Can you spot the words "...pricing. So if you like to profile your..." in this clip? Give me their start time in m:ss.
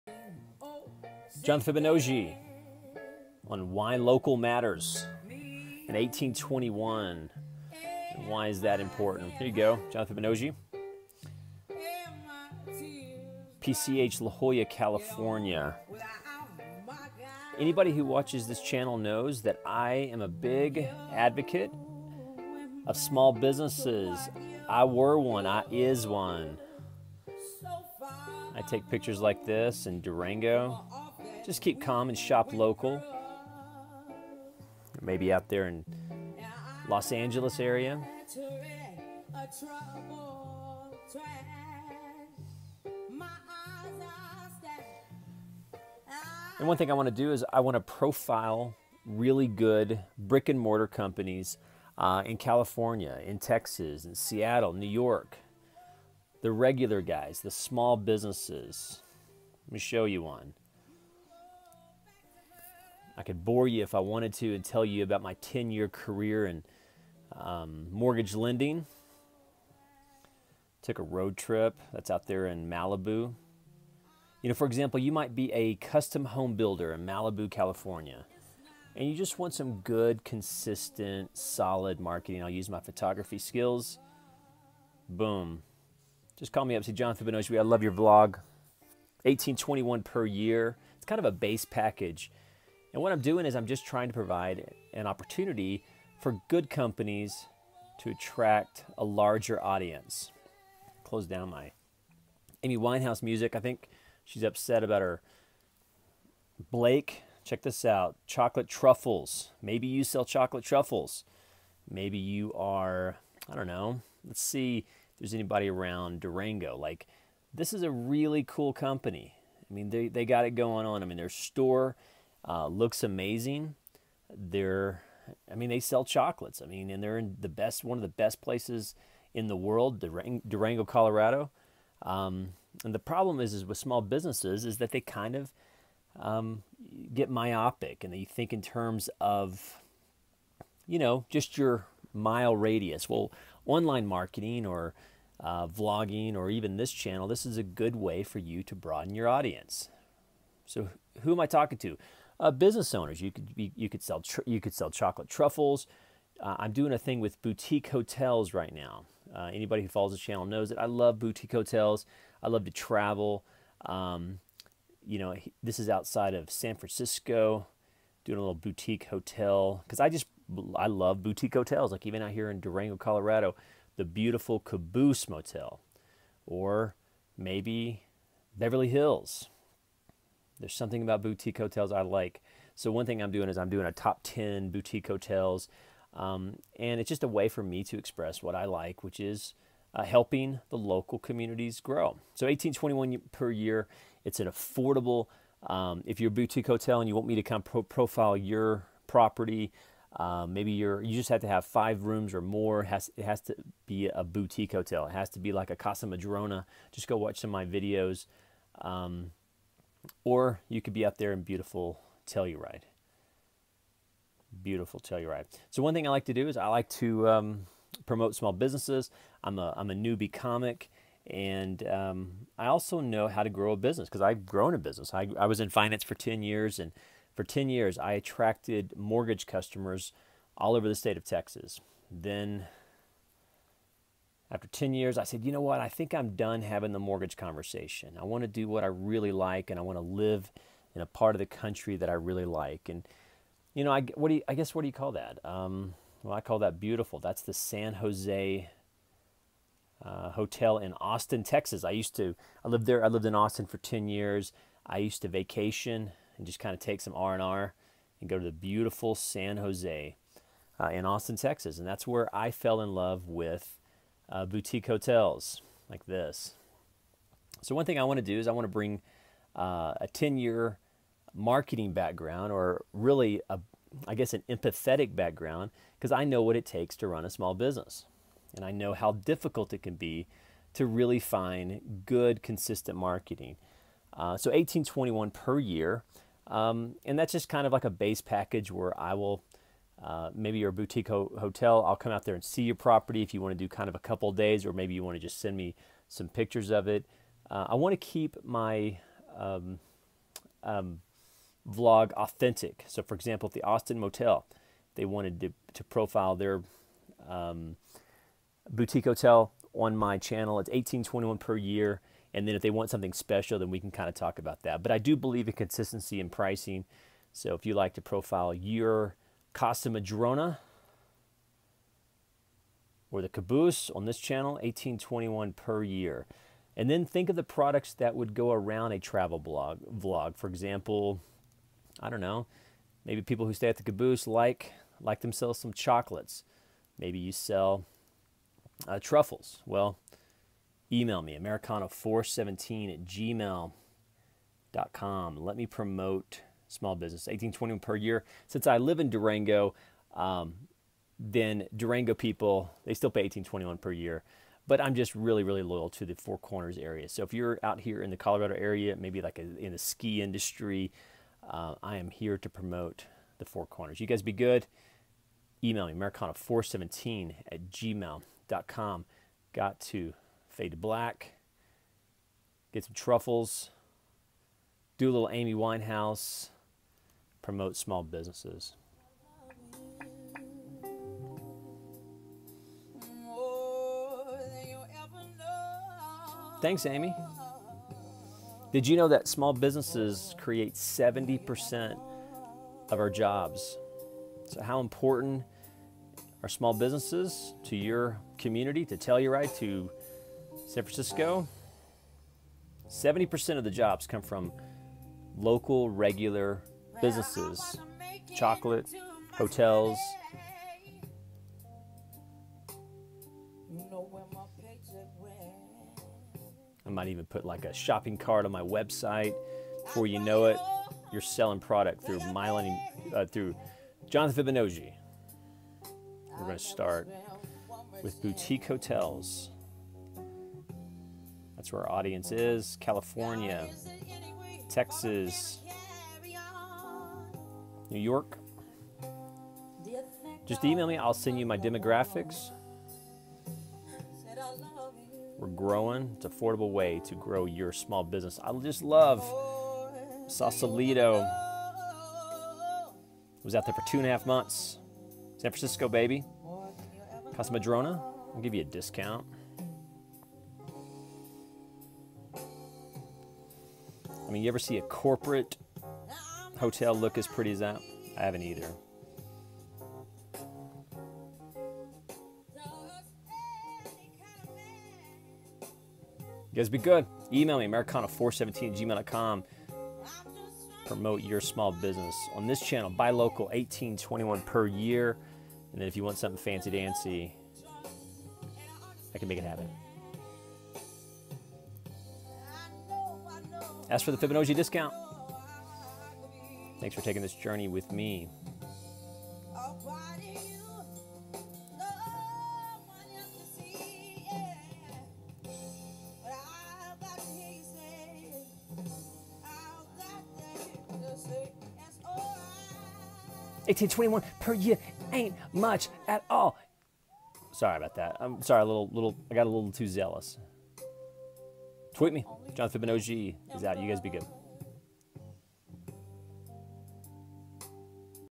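5:16.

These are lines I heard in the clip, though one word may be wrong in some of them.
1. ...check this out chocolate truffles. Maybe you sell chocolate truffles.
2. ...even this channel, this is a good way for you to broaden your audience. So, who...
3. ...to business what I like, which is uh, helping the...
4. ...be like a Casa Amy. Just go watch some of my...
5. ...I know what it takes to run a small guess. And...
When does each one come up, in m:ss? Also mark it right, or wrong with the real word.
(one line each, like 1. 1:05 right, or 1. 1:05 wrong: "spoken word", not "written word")
1. 1:47 right
2. 2:26 right
3. 3:07 wrong: "express", not "business"
4. 3:25 wrong: "Madrona", not "Amy"
5. 4:36 wrong: "business", not "guess".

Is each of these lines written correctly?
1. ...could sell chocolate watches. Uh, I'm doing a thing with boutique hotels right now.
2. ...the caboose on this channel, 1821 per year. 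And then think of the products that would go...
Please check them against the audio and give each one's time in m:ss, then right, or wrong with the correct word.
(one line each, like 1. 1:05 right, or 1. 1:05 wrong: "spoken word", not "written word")
1. 2:34 wrong: "truffles", not "watches"
2. 5:23 right.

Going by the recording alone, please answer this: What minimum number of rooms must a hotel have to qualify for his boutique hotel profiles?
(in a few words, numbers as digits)
5.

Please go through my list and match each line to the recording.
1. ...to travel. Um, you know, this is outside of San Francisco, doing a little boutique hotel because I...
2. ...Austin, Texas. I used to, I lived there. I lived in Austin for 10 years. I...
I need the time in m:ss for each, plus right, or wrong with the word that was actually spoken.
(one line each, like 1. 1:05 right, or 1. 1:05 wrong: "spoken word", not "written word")
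1. 2:42 right
2. 4:10 right.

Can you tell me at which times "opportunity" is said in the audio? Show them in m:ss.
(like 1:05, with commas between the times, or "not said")
1:35.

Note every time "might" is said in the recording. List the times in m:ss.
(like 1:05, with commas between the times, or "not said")
1:15, 6:56.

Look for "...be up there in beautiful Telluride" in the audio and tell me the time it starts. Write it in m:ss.
3:30.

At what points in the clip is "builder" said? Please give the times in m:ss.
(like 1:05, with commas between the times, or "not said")
1:16.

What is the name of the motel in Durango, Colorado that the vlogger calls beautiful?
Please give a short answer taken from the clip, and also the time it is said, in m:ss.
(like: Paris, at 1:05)
Caboose Motel, at 2:54.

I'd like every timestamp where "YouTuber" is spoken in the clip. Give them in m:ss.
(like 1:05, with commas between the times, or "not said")
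not said.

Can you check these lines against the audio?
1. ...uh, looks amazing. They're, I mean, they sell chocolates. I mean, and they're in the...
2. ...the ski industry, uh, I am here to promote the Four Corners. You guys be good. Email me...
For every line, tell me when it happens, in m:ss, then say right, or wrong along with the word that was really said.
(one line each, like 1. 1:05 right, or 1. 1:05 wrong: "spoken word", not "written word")
1. 2:02 right
2. 5:59 right.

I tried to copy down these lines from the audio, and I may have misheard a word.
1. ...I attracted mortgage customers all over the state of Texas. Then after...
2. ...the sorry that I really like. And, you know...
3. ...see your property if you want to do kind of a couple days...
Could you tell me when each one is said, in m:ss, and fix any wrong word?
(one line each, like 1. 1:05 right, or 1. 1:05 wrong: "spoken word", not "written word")
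1. 3:47 right
2. 4:01 wrong: "country", not "sorry"
3. 4:52 right.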